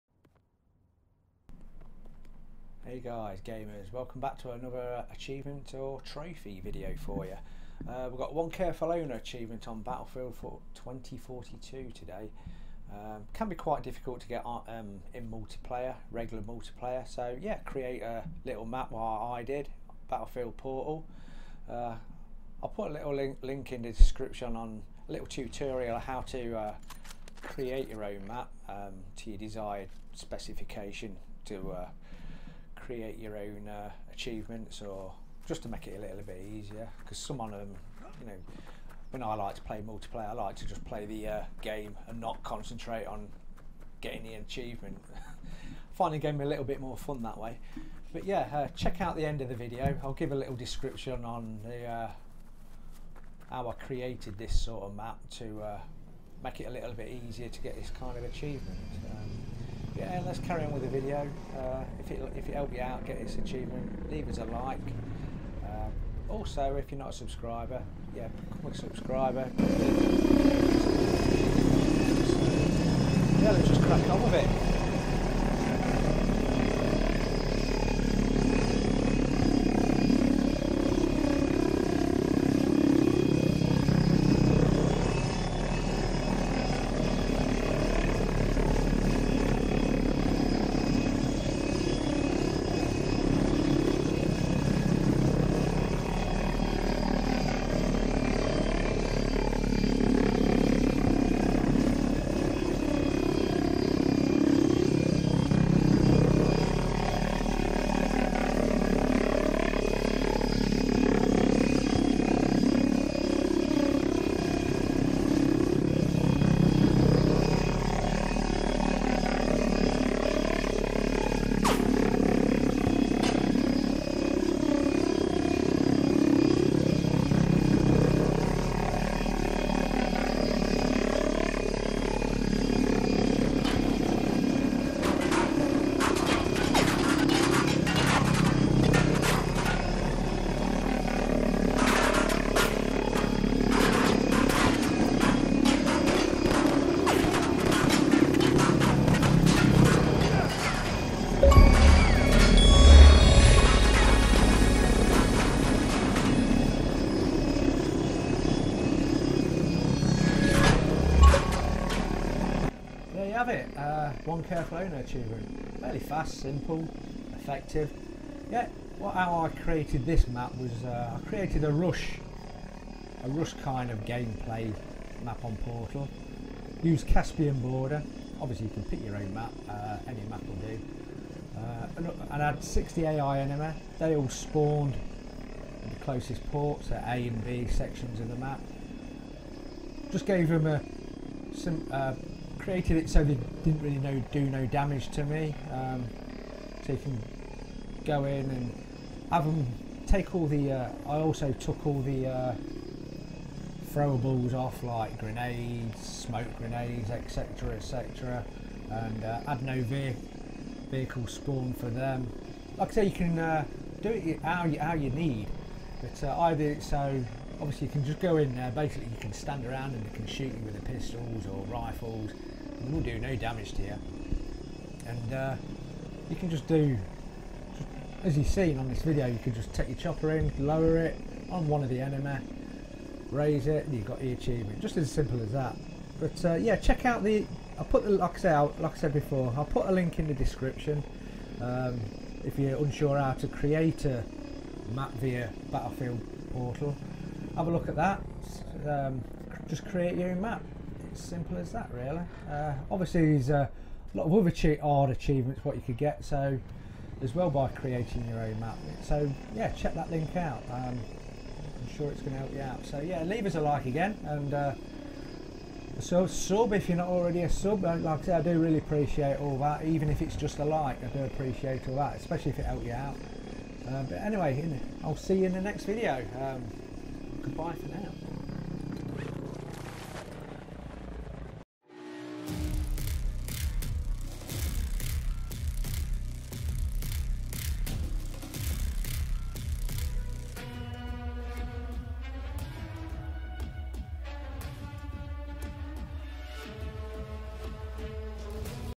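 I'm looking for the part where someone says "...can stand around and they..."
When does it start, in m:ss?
3:39.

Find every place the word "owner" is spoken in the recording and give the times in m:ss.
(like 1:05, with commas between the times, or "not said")
0:08, 2:44.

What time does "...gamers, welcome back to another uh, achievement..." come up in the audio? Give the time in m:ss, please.
0:03.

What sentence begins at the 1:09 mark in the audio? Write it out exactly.
So, yeah, let's just crack on with it.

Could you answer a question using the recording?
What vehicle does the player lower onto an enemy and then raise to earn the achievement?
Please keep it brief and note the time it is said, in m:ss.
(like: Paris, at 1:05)
Chopper, at 3:49.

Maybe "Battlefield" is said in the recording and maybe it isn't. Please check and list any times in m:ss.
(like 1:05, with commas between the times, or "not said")
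0:09, 0:20, 4:05.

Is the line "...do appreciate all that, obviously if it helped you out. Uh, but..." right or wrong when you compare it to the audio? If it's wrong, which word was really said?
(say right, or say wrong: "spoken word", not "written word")
wrong: "especially", not "obviously".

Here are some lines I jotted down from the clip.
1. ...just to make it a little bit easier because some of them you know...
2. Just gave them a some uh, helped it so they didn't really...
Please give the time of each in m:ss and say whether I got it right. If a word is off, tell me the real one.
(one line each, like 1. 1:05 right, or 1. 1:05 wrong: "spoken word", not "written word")
1. 0:35 right
2. 3:10 wrong: "created", not "helped".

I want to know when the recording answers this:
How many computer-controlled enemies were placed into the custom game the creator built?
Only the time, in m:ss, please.
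3:02.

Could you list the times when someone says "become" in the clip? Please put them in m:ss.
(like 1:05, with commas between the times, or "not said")
1:08.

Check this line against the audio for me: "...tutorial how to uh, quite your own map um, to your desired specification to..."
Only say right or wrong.
wrong.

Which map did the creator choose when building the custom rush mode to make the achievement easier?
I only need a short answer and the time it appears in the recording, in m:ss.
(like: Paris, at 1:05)
Caspian Border, at 2:57.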